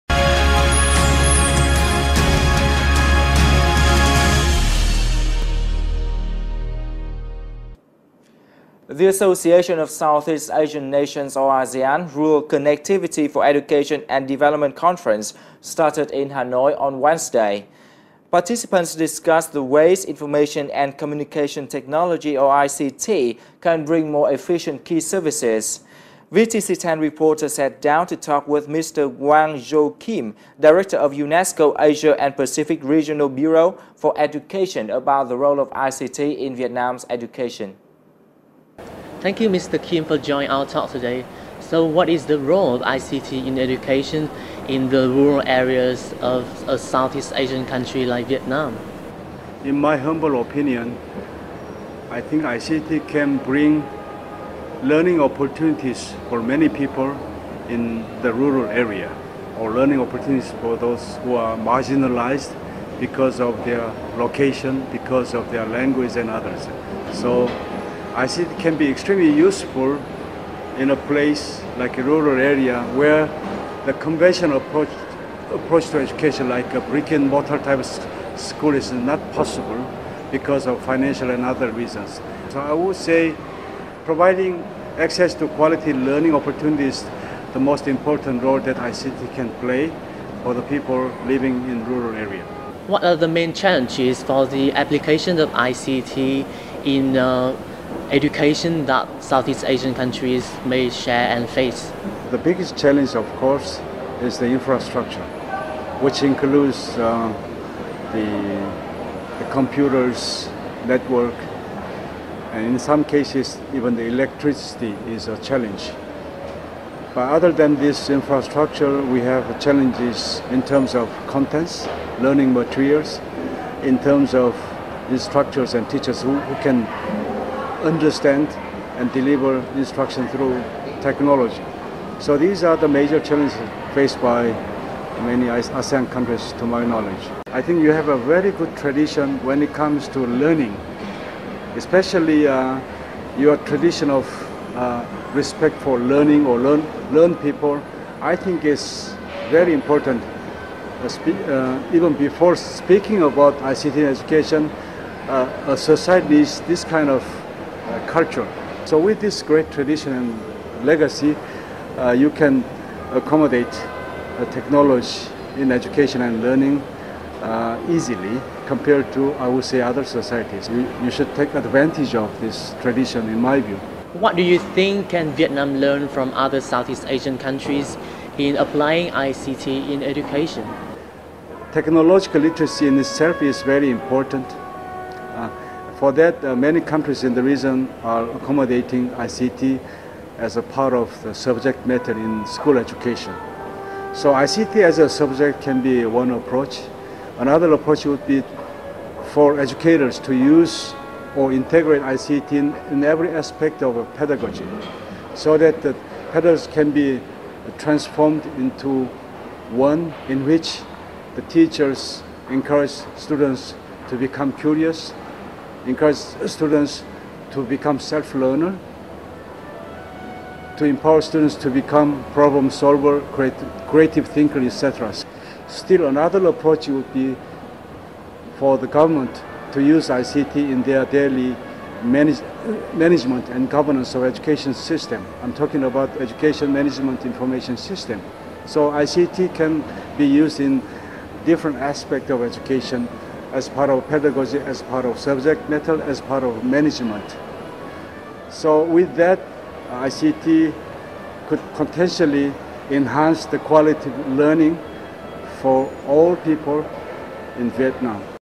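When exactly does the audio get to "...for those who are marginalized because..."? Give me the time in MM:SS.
01:00.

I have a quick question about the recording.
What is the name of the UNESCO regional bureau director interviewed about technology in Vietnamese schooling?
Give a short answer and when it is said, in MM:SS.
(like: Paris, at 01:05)
Gwang-Jo Kim, at 00:29.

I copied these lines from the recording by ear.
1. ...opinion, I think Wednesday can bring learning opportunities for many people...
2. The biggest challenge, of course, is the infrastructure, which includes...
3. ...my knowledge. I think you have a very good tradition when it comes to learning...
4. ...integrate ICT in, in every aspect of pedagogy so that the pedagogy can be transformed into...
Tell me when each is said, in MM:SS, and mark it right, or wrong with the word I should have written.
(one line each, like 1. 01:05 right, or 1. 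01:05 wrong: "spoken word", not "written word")
1. 00:50 wrong: "ICT", not "Wednesday"
2. 01:42 right
3. 02:16 right
4. 03:21 right.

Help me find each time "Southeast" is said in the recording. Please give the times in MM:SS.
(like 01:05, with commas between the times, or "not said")
00:09, 00:46, 01:39, 02:56.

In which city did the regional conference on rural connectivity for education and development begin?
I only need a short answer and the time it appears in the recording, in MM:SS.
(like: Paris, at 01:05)
Hanoi, at 00:16.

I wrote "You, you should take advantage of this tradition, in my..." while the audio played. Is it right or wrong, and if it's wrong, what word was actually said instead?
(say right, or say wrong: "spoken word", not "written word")
right.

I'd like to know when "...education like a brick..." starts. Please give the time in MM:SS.
01:15.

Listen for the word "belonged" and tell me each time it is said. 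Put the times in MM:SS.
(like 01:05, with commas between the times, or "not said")
not said.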